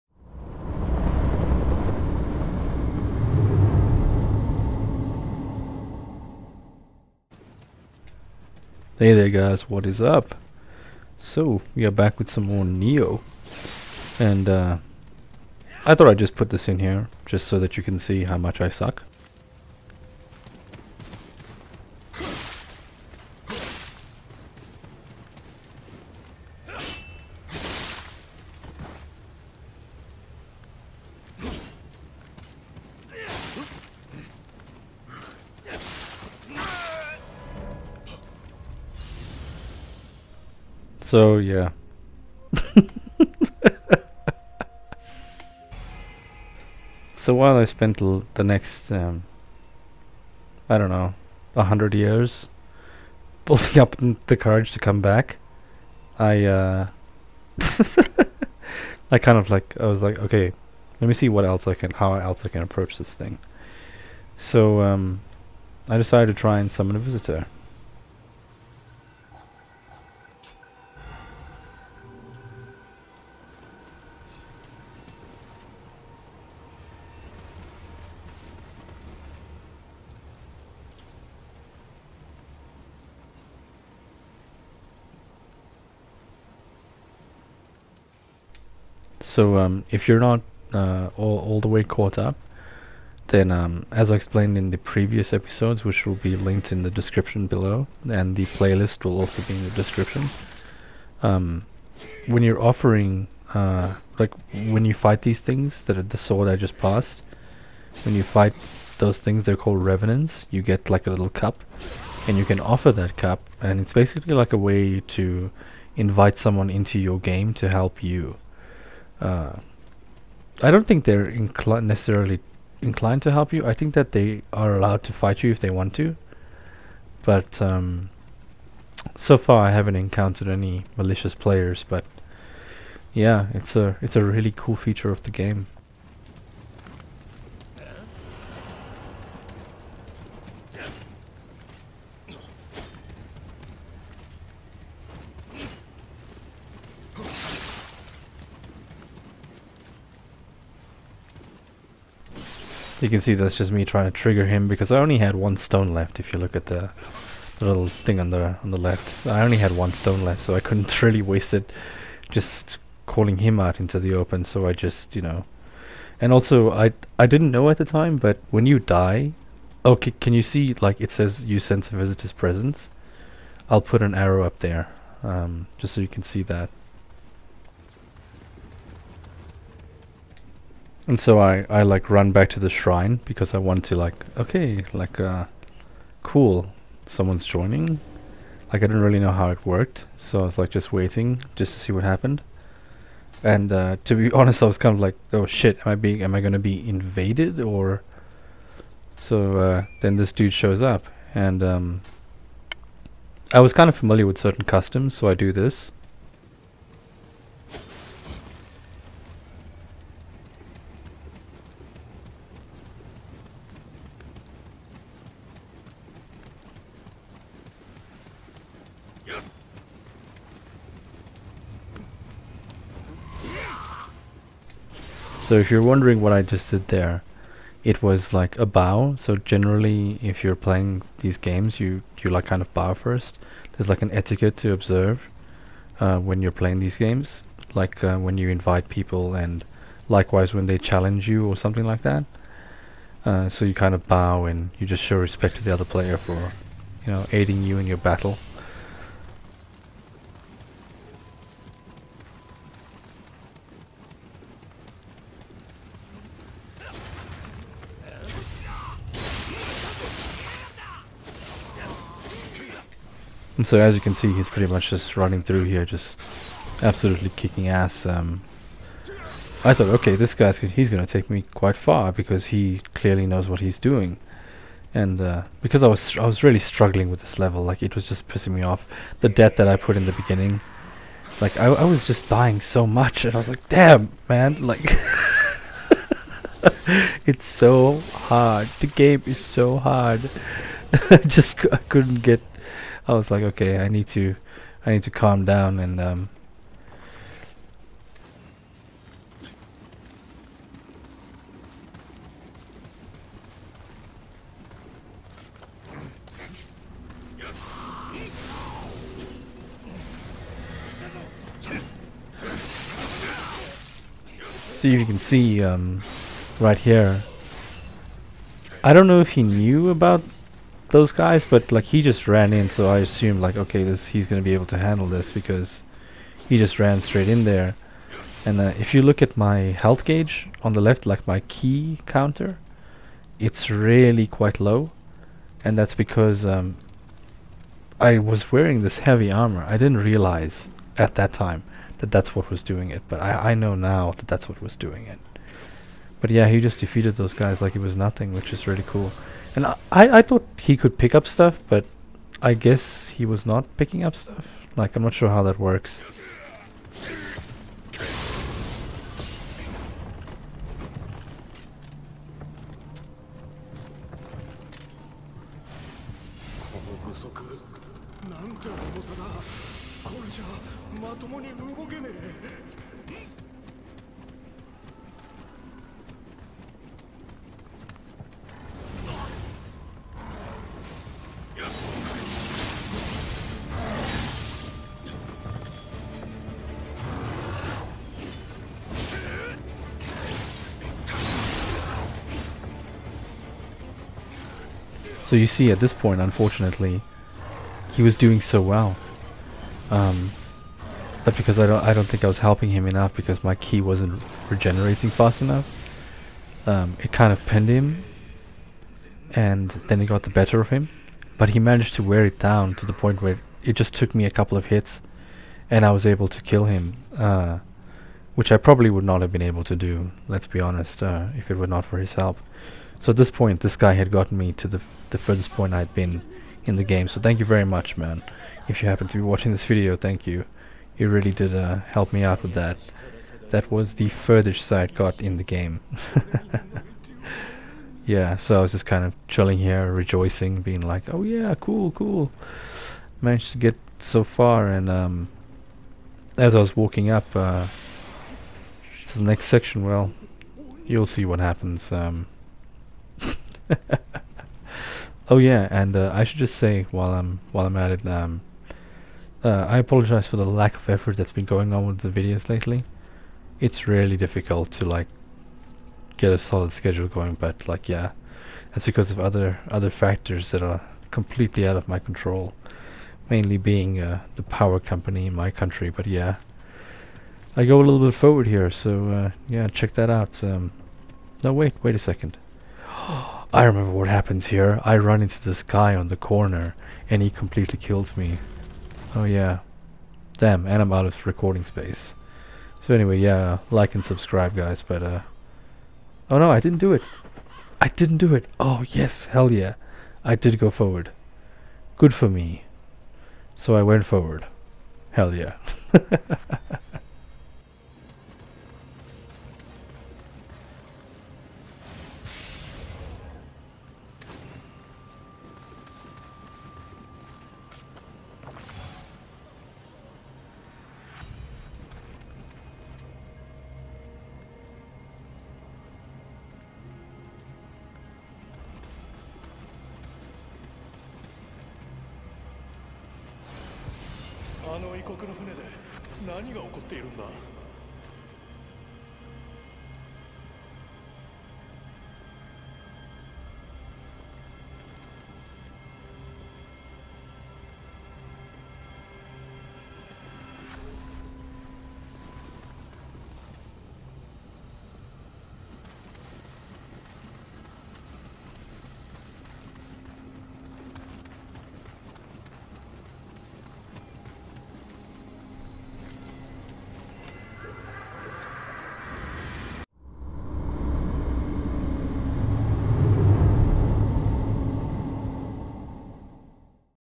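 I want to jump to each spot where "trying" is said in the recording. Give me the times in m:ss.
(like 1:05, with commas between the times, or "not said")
2:33.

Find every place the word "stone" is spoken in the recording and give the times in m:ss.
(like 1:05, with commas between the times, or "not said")
2:35, 2:39.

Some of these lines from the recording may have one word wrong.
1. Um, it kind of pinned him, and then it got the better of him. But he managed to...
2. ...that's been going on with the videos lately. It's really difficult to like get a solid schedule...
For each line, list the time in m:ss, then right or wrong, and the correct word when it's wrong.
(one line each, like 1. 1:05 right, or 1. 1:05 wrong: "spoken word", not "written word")
1. 6:46 right
2. 7:41 right.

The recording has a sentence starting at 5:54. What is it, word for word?
Like, I'm not sure how that works.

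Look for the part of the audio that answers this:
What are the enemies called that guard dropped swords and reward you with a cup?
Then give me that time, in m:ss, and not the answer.
1:49.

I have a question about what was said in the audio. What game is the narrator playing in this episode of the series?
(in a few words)
Nioh.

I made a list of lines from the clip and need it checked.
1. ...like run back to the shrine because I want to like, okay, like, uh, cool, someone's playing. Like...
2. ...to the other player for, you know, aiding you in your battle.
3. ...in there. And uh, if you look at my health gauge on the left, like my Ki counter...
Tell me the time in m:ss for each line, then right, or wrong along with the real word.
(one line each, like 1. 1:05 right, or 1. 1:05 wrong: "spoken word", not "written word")
1. 3:01 wrong: "joining", not "playing"
2. 4:05 right
3. 5:27 right.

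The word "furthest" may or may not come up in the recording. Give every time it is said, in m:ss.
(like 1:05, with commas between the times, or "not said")
7:05, 7:14.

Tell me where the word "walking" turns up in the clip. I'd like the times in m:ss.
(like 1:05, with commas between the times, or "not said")
7:26.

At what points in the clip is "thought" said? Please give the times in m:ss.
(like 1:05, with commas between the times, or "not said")
0:15, 4:29, 5:50.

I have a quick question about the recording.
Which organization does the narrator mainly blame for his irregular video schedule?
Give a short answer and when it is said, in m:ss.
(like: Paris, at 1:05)
the power company, at 7:54.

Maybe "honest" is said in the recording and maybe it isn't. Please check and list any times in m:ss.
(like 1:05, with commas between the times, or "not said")
3:14, 7:00.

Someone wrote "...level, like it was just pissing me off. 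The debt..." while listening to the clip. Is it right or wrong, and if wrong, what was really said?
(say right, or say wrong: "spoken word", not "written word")
right.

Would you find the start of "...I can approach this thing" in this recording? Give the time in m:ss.
1:02.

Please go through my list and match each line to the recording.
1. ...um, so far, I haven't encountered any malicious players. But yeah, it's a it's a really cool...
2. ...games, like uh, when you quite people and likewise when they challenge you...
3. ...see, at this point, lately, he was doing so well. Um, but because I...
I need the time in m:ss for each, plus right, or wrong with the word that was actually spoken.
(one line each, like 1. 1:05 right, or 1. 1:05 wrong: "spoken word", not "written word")
1. 2:07 right
2. 3:56 wrong: "invite", not "quite"
3. 6:35 wrong: "unfortunately", not "lately".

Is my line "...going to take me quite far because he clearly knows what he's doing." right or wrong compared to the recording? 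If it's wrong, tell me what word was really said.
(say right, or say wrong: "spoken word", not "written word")
right.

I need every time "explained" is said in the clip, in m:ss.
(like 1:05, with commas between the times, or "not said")
1:34.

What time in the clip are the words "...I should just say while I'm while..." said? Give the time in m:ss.
7:36.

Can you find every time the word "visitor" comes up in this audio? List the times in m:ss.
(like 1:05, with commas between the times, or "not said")
1:06, 2:51.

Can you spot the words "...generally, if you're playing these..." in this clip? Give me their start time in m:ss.
3:49.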